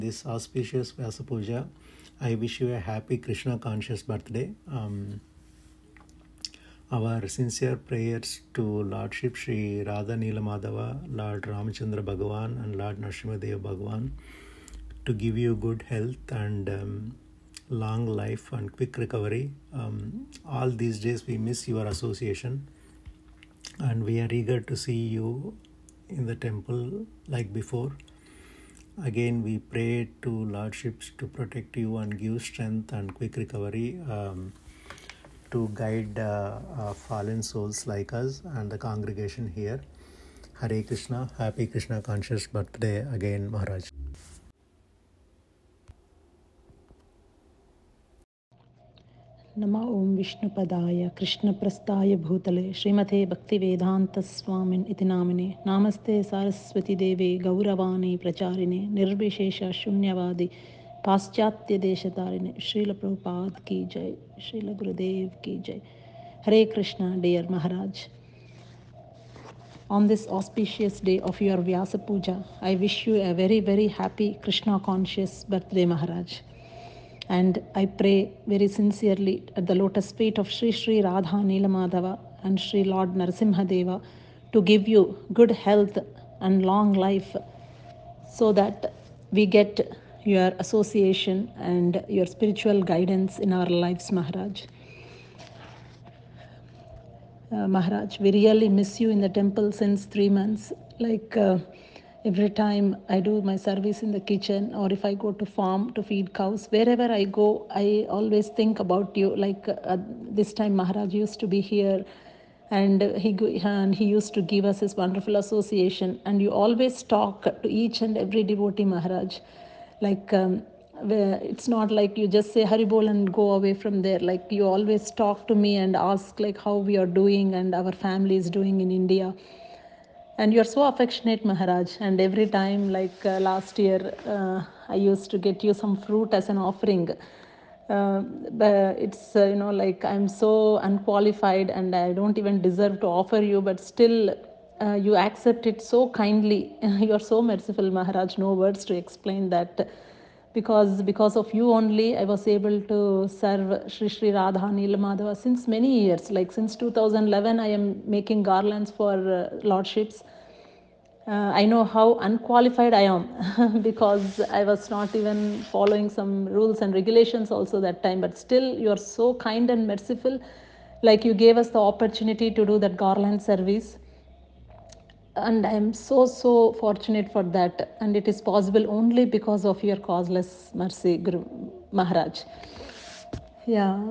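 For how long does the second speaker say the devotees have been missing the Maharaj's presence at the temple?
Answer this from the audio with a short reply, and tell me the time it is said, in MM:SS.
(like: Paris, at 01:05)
three months, at 01:40.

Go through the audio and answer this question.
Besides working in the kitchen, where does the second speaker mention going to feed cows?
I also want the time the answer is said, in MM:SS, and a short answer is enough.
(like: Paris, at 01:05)
farm, at 01:45.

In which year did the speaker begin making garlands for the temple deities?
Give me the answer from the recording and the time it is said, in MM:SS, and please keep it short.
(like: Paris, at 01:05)
2011, at 02:36.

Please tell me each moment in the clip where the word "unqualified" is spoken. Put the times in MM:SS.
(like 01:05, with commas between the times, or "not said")
02:20, 02:42.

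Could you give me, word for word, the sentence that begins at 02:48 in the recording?
But still, you are so kind and merciful.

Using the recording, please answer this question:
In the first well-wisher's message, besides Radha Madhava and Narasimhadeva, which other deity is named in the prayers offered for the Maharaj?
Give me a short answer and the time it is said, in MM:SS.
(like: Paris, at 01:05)
Lord Ramachandra, at 00:11.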